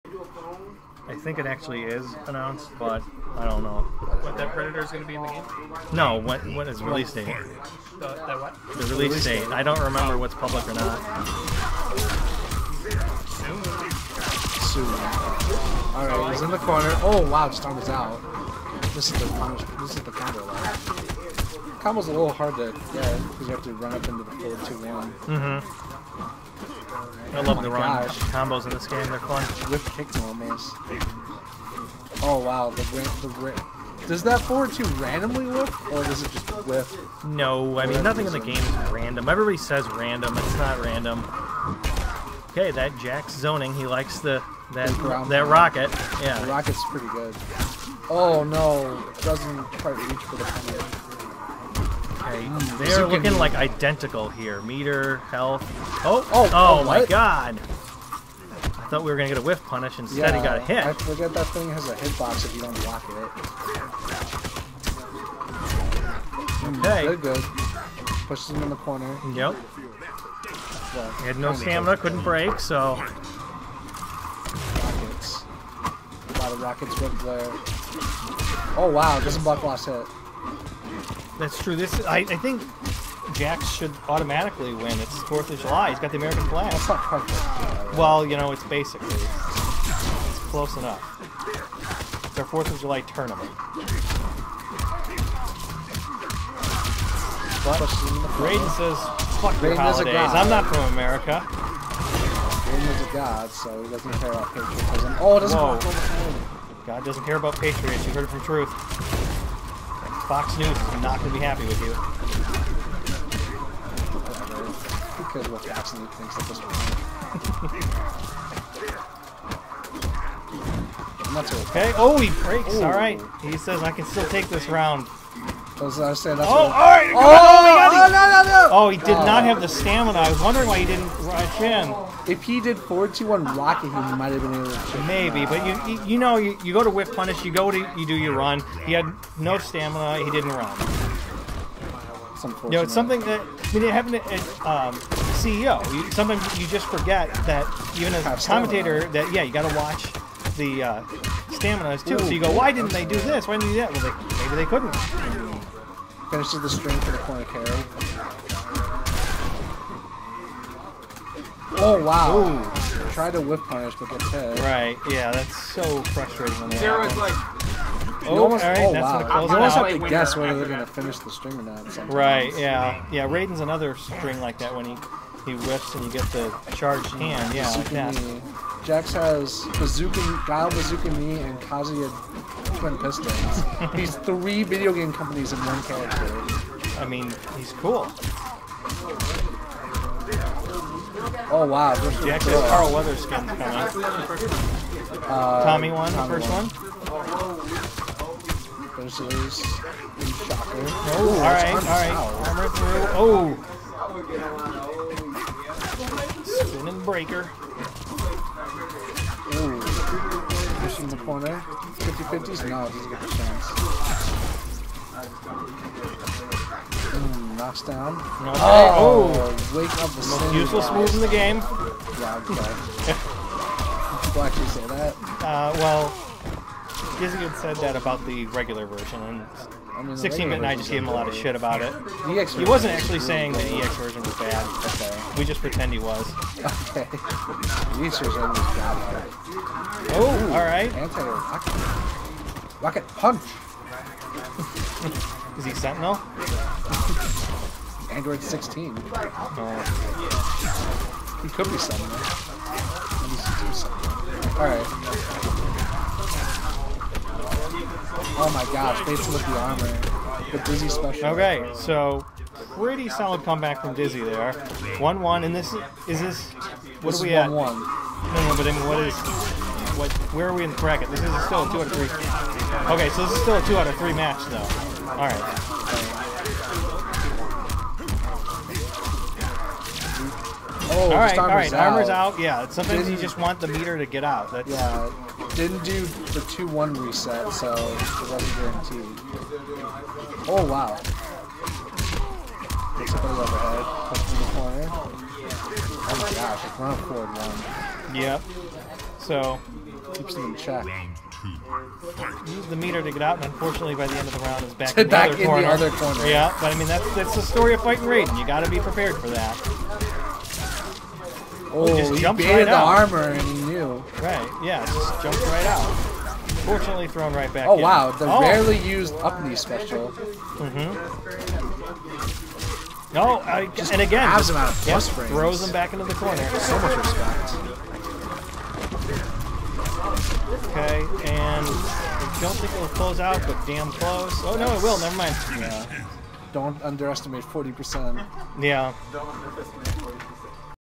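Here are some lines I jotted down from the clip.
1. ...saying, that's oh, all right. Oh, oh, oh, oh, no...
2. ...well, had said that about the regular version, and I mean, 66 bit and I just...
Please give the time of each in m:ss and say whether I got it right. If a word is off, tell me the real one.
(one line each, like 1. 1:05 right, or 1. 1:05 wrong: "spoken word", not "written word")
1. 2:06 right
2. 3:45 wrong: "16", not "66".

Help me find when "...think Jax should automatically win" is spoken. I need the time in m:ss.
1:22.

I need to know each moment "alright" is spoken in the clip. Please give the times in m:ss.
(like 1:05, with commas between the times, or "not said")
4:00, 4:14, 4:35.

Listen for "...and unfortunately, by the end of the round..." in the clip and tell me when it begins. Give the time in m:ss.
5:03.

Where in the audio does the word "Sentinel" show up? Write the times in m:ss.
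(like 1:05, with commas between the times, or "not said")
4:05, 4:11.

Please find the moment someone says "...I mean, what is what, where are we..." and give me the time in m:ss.
4:28.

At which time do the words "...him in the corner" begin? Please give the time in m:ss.
1:08.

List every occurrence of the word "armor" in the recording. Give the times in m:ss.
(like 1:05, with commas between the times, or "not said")
3:22, 4:19, 4:41, 5:12.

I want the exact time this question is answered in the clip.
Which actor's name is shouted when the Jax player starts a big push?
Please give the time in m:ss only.
3:12.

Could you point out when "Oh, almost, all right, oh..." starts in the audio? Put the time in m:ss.
2:48.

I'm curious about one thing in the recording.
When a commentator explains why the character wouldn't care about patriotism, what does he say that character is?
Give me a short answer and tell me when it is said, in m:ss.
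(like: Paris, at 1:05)
A god, at 1:42.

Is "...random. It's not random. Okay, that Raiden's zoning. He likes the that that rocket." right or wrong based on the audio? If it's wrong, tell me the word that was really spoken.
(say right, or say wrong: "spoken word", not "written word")
wrong: "Jax", not "Raiden".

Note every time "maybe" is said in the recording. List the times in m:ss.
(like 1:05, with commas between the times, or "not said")
2:15, 2:34.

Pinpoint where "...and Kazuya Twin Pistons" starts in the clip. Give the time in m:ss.
3:01.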